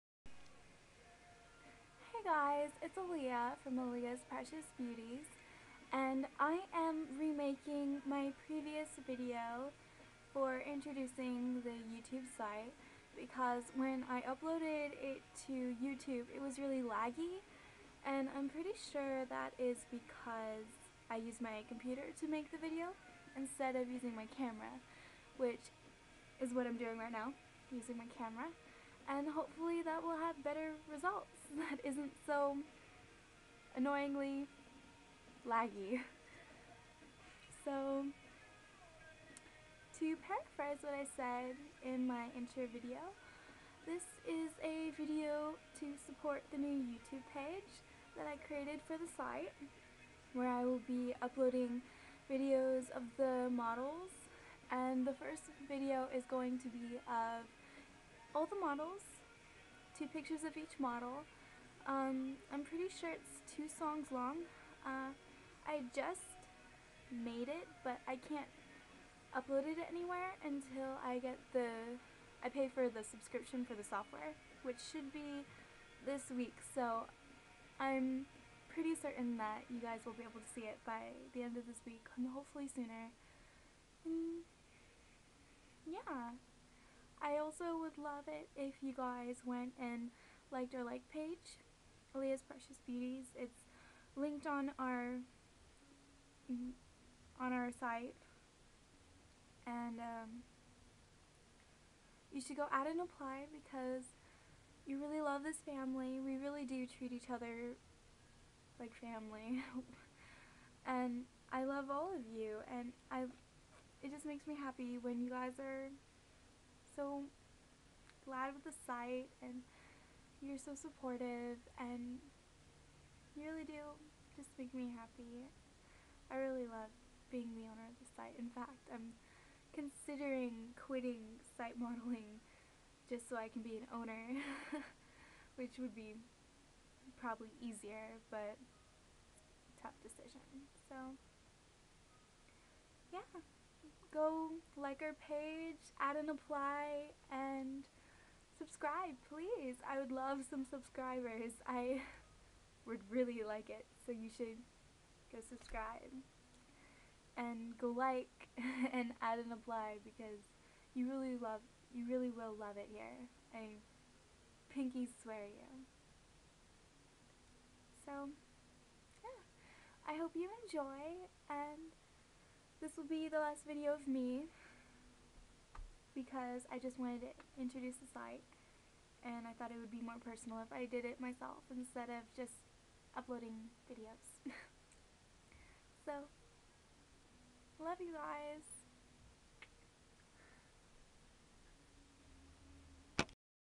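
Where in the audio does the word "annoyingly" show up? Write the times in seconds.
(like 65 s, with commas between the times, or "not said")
33 s.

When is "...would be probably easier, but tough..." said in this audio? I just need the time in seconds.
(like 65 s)
135 s.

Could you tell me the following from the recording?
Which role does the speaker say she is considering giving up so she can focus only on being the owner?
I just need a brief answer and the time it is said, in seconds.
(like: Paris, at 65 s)
Site modeling, at 131 s.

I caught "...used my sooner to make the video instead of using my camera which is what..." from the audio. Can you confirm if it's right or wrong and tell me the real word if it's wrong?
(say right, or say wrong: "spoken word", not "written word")
wrong: "computer", not "sooner".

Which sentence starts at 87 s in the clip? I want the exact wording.
I also would love it if you guys went and liked our like page, Leah's Precious Beauties.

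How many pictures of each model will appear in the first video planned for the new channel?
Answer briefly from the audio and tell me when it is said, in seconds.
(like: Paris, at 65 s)
2, at 59 s.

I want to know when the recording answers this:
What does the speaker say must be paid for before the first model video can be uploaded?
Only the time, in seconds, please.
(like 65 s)
72 s.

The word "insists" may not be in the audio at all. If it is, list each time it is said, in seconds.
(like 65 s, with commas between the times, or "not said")
not said.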